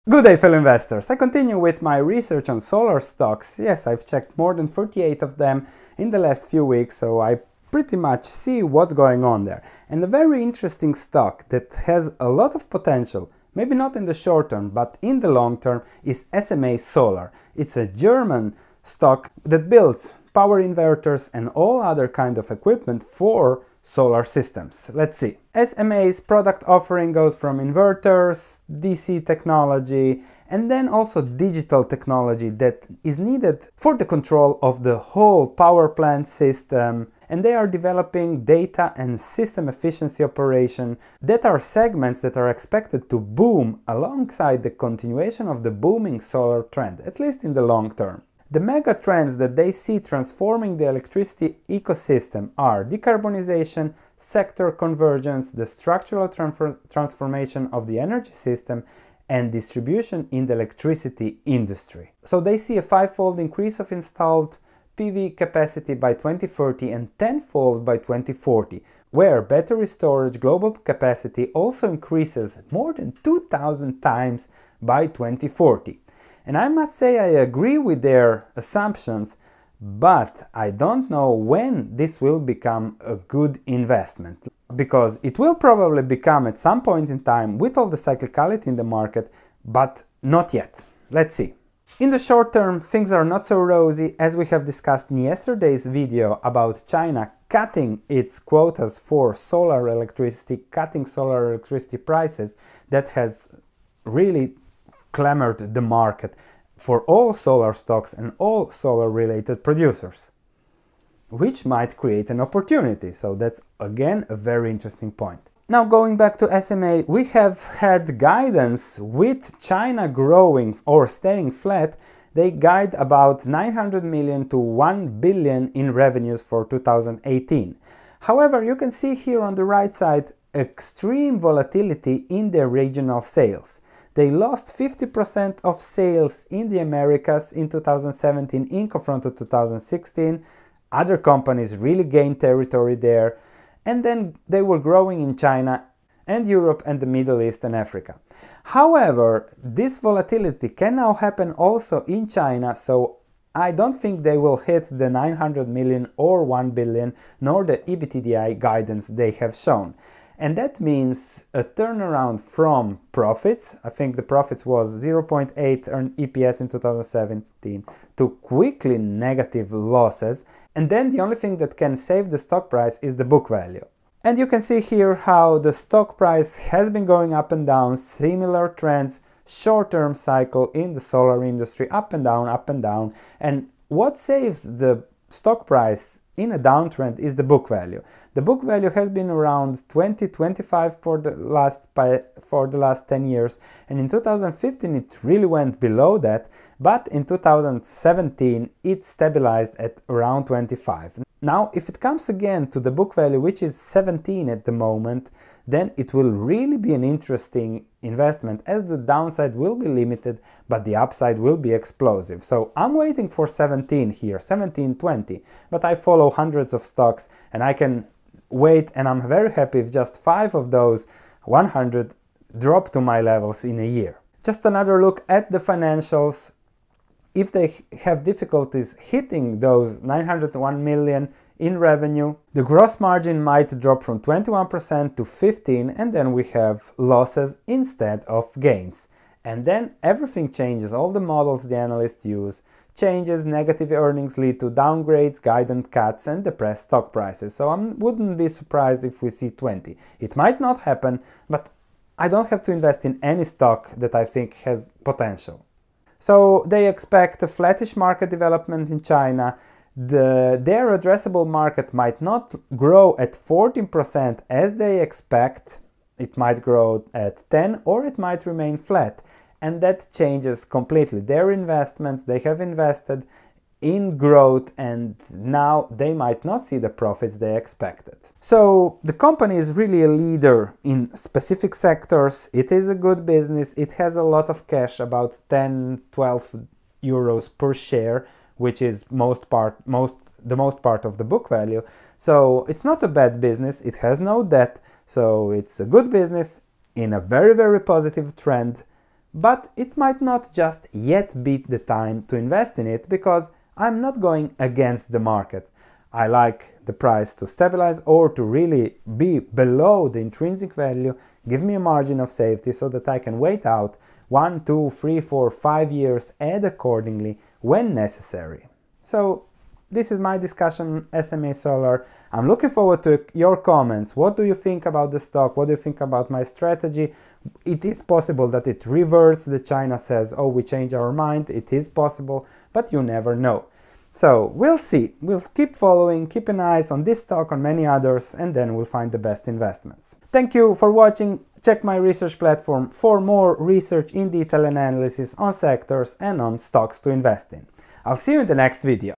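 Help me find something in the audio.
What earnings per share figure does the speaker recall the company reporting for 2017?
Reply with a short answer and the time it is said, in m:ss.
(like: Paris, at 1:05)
0.8, at 2:45.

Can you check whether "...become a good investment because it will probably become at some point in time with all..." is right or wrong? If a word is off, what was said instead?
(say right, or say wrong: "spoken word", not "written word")
right.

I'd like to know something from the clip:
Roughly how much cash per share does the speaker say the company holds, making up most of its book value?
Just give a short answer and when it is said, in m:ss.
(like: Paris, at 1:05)
10 to 12 euros, at 4:45.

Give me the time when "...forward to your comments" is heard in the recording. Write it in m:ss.
5:22.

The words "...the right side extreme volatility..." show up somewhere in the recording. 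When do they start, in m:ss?
2:09.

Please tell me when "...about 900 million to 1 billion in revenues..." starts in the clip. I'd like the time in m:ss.
2:02.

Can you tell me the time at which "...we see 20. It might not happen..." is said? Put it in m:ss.
4:09.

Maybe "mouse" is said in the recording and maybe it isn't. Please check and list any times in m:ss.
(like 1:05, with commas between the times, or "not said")
not said.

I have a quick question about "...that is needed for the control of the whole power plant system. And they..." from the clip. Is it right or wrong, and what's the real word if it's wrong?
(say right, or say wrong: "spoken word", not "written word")
right.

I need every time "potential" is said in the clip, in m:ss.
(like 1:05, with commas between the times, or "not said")
0:12, 4:15.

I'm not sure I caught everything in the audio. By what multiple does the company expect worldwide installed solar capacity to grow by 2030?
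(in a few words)
five-fold.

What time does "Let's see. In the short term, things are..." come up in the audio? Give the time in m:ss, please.
1:31.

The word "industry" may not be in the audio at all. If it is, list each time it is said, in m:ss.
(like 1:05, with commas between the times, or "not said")
1:01, 3:01.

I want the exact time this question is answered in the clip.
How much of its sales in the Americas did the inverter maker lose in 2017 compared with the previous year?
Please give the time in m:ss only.
2:14.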